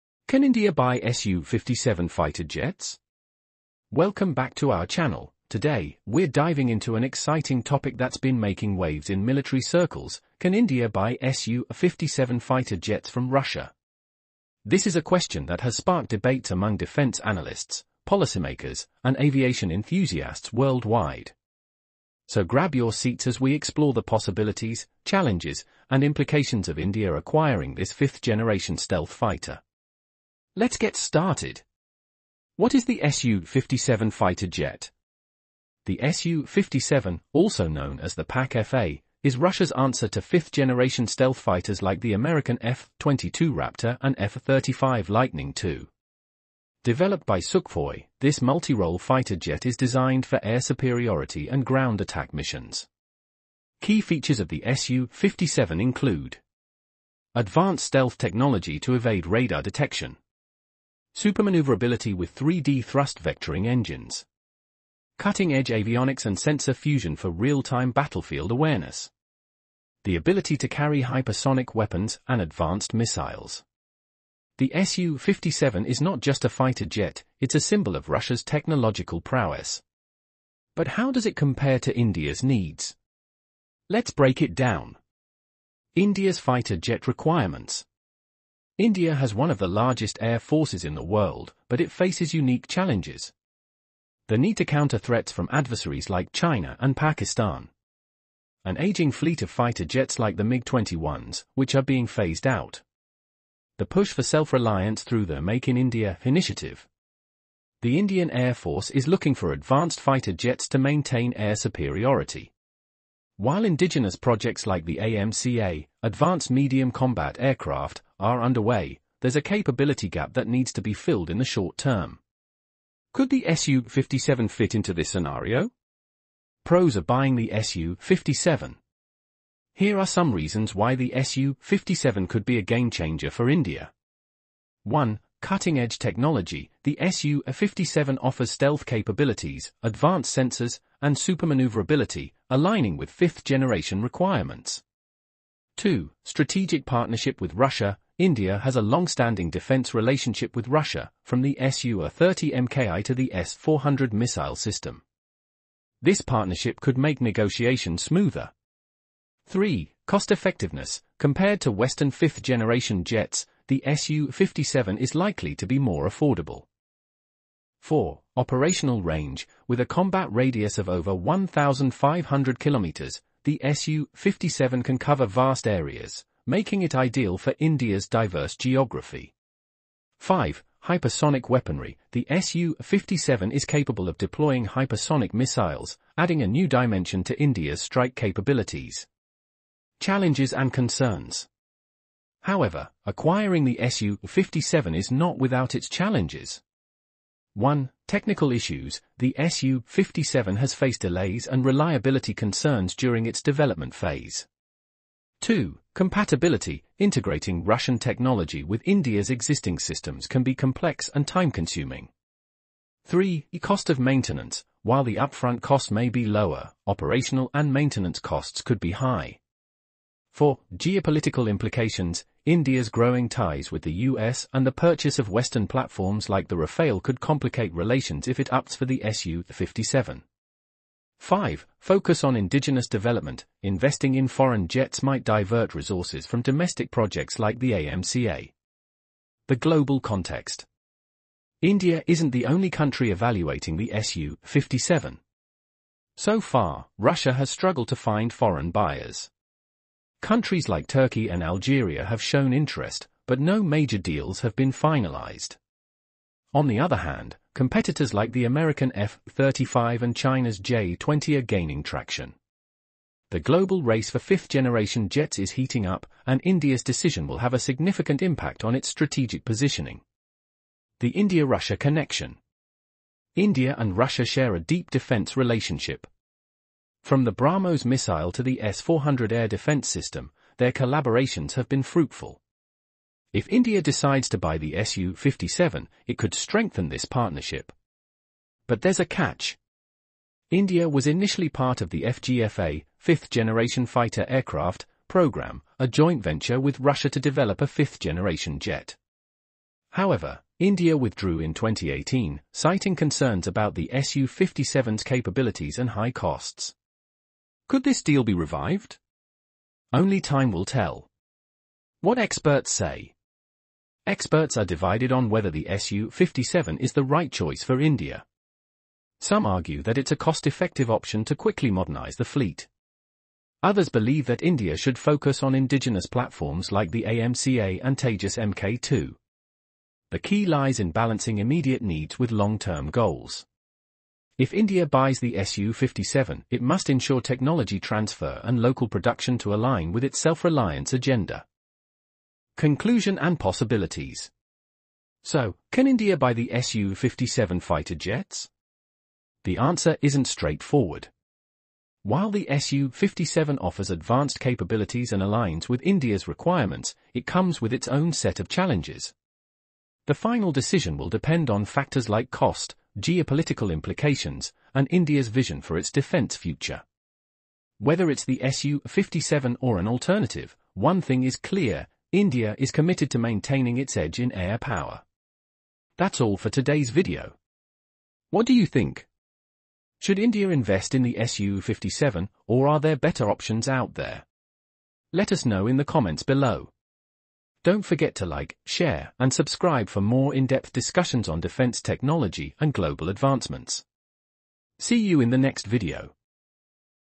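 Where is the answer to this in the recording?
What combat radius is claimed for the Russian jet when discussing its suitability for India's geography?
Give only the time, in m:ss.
2:50.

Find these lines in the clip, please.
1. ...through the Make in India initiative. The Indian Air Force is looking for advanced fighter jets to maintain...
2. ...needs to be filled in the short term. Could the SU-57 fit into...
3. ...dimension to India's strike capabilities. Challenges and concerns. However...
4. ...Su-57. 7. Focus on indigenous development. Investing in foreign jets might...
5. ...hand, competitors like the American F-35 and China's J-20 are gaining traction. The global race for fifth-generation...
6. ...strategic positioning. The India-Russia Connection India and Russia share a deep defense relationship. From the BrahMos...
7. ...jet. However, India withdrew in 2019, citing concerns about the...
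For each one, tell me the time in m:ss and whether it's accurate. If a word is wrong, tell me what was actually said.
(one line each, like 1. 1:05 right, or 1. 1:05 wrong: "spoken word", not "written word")
1. 1:45 right
2. 2:00 right
3. 3:06 right
4. 3:49 wrong: "5", not "7"
5. 4:16 right
6. 4:28 right
7. 4:58 wrong: "2018", not "2019".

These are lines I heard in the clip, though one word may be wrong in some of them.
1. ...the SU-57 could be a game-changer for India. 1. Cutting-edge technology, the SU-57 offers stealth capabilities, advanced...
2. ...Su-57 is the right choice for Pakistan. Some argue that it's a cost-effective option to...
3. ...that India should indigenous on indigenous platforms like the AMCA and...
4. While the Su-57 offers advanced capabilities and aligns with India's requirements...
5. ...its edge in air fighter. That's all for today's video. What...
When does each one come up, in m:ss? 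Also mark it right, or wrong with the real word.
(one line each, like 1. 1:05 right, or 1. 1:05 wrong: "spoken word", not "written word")
1. 2:10 right
2. 5:15 wrong: "India", not "Pakistan"
3. 5:24 wrong: "focus", not "indigenous"
4. 5:52 right
5. 6:13 wrong: "power", not "fighter".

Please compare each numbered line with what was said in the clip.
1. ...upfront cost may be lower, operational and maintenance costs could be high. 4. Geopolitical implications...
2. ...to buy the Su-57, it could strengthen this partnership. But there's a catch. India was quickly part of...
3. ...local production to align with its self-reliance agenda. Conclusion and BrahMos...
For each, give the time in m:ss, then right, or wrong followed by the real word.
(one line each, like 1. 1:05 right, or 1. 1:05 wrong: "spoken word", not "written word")
1. 3:35 right
2. 4:44 wrong: "initially", not "quickly"
3. 5:38 wrong: "Possibilities", not "BrahMos".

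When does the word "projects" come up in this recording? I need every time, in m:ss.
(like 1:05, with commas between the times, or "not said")
1:54, 3:56.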